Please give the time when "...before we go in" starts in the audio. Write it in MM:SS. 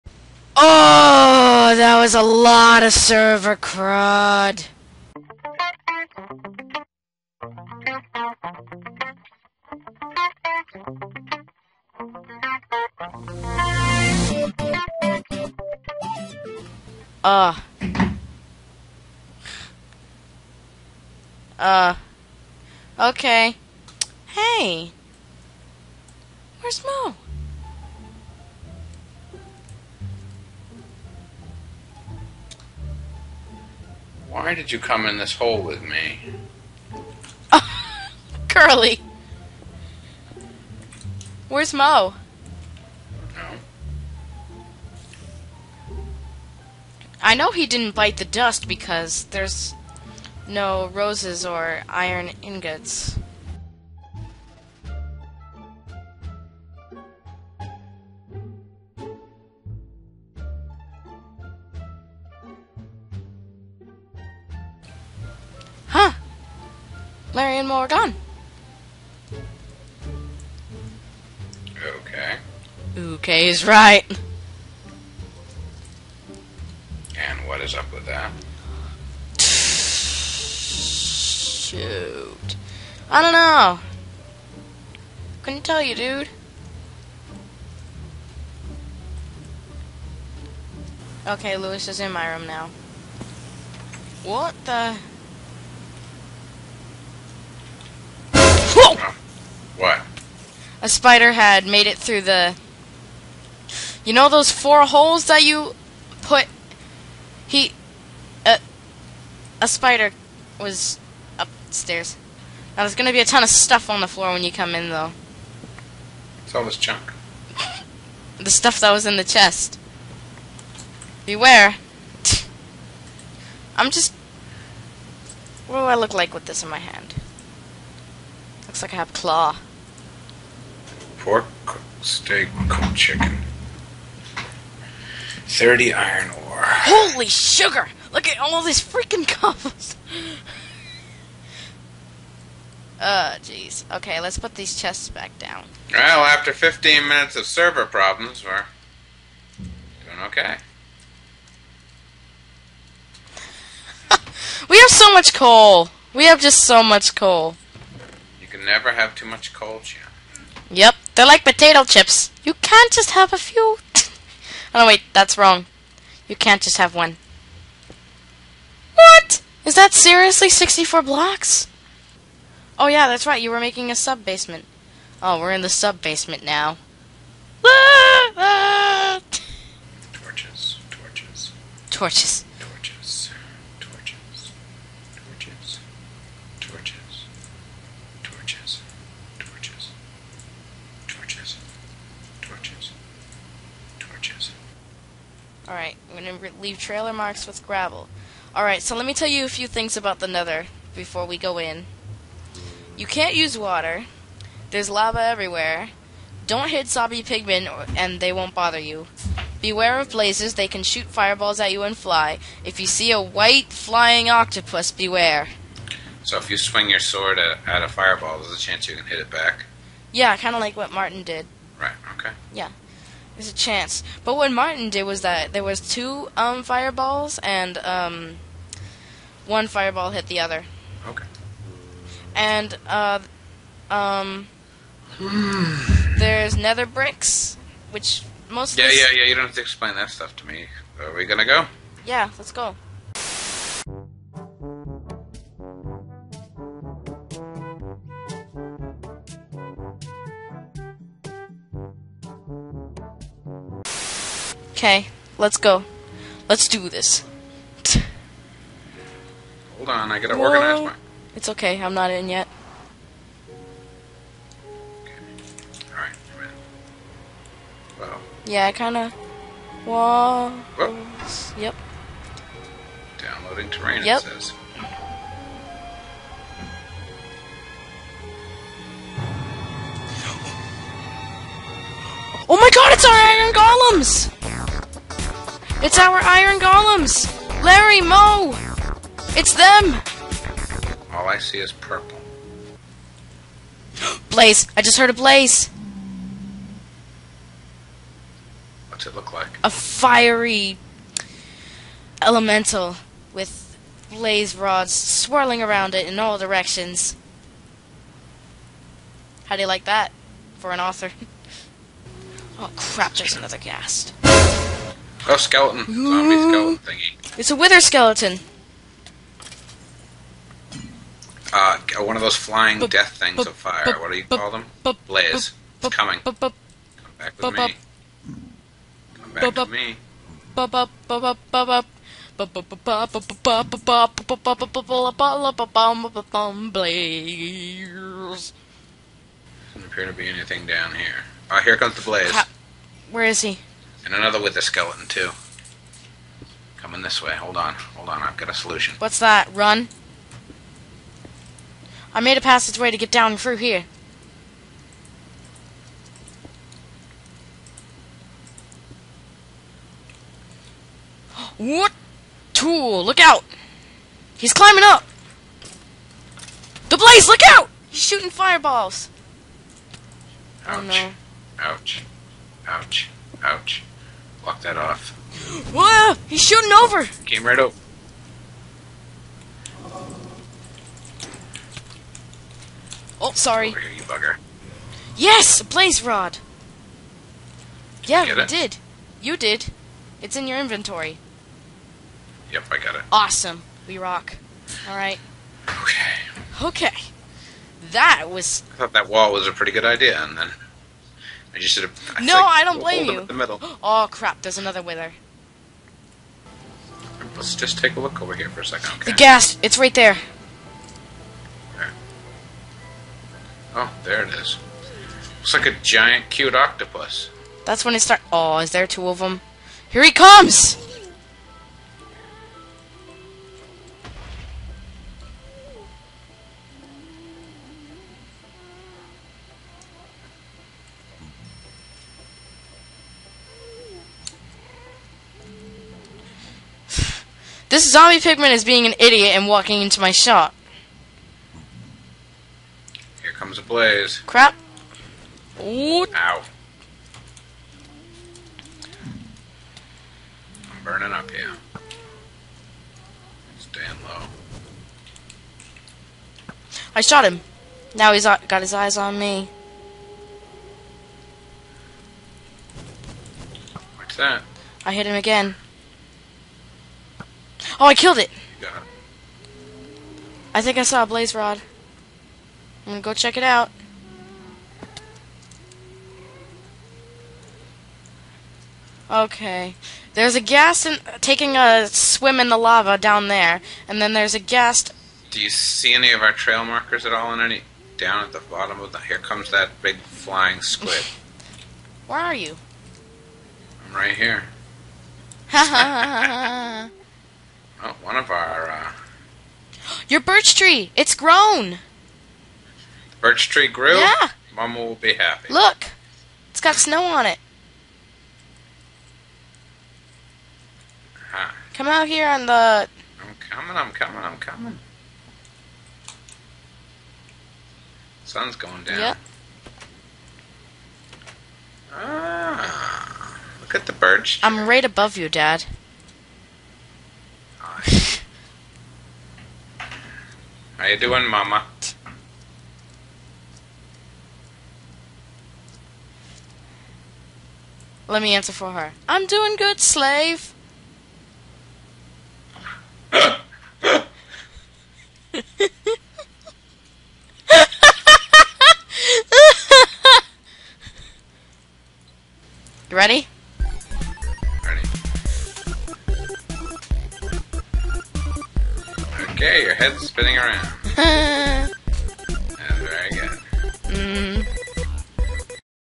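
03:20.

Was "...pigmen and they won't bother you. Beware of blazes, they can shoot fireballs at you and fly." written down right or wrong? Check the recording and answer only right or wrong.
right.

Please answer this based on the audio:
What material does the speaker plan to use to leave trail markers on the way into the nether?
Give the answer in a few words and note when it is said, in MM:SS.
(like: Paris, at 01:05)
Gravel, at 03:17.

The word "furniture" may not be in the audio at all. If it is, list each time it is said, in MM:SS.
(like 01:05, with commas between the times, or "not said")
not said.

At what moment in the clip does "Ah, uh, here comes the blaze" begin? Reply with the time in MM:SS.
05:41.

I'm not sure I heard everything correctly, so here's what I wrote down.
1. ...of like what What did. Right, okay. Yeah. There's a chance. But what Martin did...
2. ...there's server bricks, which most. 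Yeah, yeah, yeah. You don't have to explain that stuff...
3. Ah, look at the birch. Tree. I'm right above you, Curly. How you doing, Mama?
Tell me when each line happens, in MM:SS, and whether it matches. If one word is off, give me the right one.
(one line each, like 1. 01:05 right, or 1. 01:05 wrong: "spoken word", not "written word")
1. 03:40 wrong: "Martin", not "What"
2. 03:55 wrong: "nether", not "server"
3. 08:41 wrong: "Dad", not "Curly".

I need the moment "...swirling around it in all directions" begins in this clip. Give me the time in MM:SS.
05:04.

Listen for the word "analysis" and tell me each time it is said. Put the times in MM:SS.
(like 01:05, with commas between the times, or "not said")
not said.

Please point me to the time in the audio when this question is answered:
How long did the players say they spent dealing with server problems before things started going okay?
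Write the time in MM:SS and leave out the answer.
02:26.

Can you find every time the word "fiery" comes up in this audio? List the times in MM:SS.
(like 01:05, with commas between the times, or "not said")
04:59.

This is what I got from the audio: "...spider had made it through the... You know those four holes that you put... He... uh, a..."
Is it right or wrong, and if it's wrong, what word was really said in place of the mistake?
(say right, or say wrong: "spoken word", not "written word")
right.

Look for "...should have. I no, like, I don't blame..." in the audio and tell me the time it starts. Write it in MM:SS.
06:41.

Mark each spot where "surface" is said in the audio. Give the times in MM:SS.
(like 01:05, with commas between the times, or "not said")
not said.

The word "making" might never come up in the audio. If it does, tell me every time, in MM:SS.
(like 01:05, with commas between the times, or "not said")
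02:53.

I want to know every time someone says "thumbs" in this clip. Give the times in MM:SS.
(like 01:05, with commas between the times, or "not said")
not said.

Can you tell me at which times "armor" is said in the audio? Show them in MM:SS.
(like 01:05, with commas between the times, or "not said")
not said.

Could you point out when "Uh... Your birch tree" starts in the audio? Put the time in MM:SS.
08:18.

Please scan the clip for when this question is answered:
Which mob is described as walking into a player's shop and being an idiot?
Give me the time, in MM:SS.
07:17.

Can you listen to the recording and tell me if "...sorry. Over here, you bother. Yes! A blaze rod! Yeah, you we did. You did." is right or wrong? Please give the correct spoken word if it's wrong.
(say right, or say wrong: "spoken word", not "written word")
wrong: "bugger", not "bother".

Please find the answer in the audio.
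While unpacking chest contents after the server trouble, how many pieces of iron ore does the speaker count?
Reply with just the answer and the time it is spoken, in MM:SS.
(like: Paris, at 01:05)
30, at 02:15.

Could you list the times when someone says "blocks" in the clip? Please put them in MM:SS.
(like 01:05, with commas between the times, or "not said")
02:51, 06:14.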